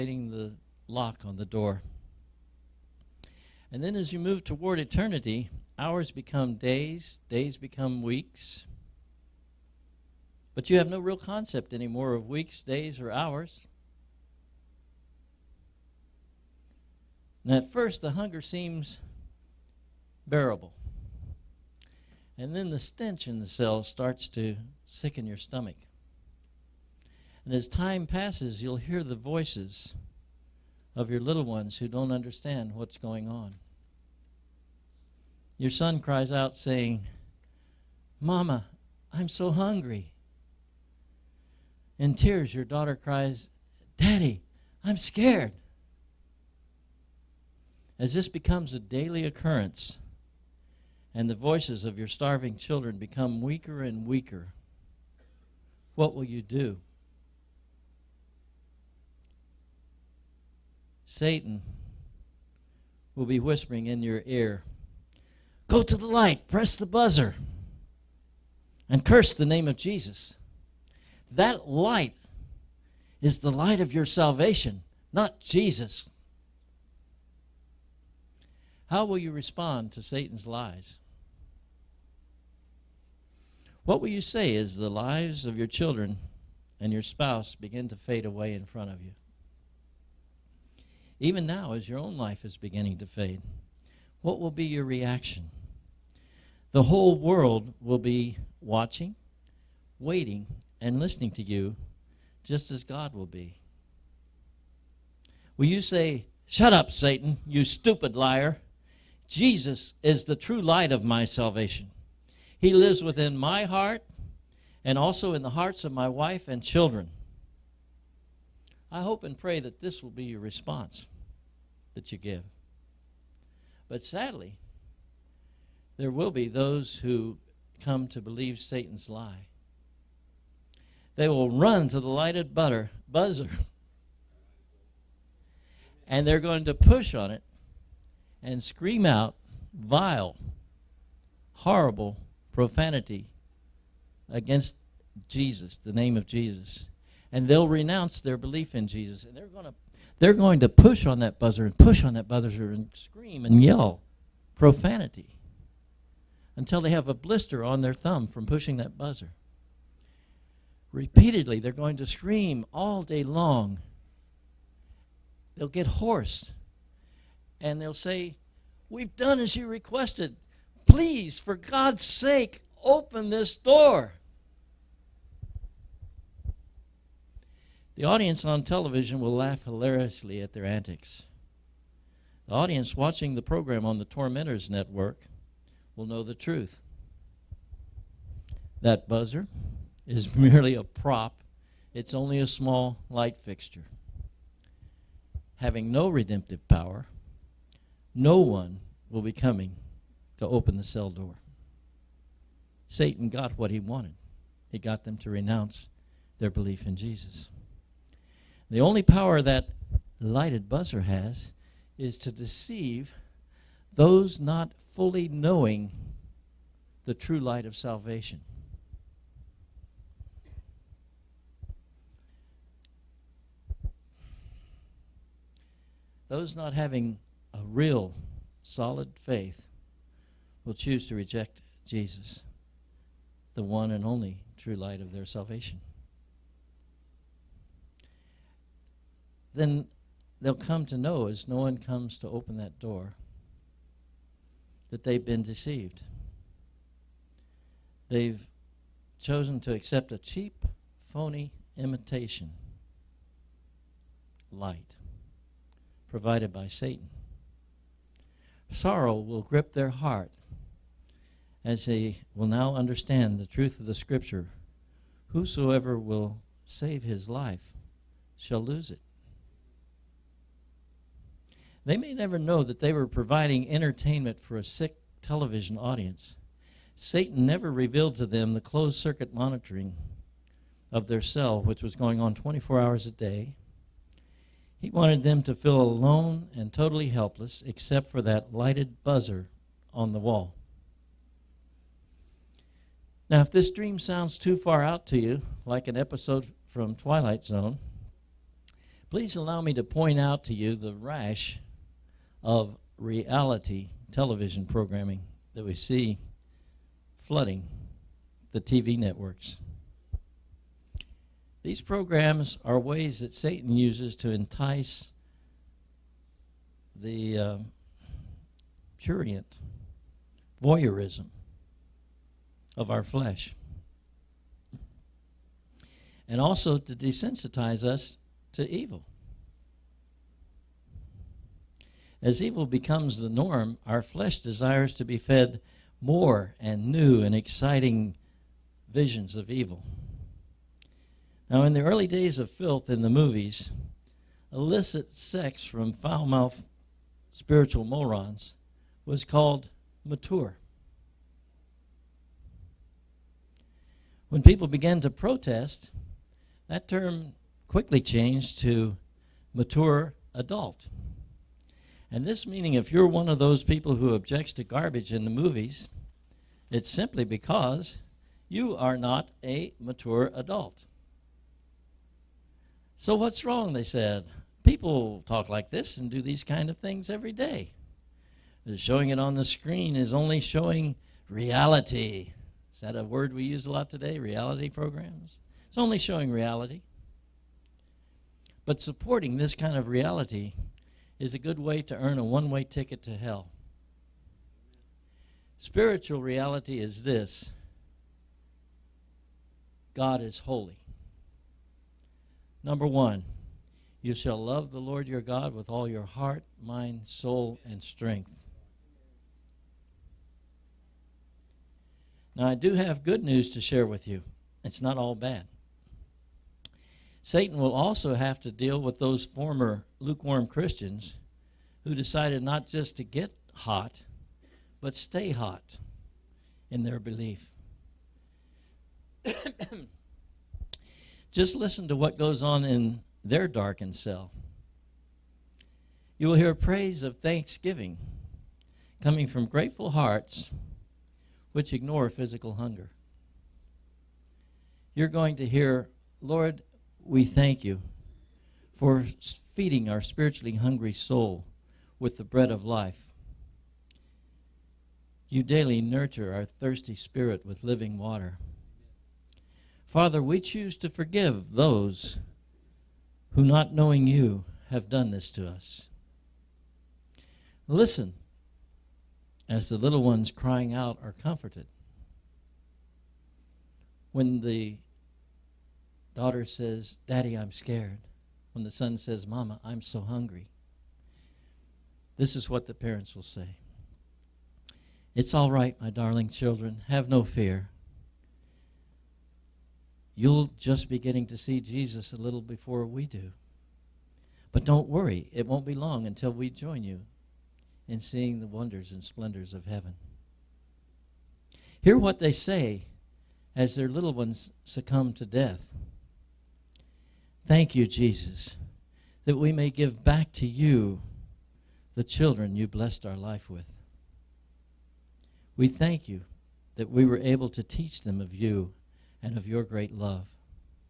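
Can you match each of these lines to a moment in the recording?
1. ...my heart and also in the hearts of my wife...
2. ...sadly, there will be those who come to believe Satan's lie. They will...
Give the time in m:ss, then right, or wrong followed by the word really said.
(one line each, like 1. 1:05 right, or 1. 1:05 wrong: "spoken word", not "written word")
1. 1:53 right
2. 2:04 right.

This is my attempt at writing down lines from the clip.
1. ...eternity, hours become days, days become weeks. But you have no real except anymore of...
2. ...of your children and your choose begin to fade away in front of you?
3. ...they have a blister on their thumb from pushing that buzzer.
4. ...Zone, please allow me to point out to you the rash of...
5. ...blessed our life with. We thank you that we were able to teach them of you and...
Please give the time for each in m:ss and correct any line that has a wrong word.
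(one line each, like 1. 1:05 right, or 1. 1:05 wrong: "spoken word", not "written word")
1. 0:04 wrong: "concept", not "except"
2. 1:25 wrong: "spouse", not "choose"
3. 2:36 right
4. 4:57 right
5. 8:32 right.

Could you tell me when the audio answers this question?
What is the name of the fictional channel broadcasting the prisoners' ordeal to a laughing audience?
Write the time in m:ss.
3:04.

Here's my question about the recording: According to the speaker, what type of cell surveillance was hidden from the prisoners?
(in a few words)
Closed circuit monitoring.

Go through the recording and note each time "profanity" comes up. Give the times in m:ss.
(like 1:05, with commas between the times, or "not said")
2:22, 2:34.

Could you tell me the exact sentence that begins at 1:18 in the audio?
How will you respond to Satan's lies?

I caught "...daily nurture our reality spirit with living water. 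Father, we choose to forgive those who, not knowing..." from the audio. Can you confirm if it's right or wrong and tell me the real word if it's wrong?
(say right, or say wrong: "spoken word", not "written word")
wrong: "thirsty", not "reality".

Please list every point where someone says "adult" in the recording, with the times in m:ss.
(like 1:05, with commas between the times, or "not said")
6:00, 6:10.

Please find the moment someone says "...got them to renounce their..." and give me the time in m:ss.
3:24.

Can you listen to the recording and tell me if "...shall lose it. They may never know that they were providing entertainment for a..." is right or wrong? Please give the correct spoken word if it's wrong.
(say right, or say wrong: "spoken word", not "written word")
right.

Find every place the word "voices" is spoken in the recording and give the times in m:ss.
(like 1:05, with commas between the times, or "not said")
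0:29, 0:51.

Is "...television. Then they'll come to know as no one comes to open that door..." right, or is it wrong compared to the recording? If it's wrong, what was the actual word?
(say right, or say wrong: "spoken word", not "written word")
wrong: "salvation", not "television".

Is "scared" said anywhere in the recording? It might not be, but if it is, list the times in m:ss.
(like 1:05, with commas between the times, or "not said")
0:44, 7:57.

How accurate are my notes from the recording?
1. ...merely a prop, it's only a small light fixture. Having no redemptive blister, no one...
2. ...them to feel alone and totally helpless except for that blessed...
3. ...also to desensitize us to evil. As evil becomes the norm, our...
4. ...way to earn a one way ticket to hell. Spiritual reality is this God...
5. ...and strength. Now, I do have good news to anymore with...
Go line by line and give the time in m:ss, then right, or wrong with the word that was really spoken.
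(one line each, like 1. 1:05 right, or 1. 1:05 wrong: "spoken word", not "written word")
1. 3:10 wrong: "power", not "blister"
2. 4:45 wrong: "lighted", not "blessed"
3. 5:26 right
4. 6:31 right
5. 6:47 wrong: "share", not "anymore".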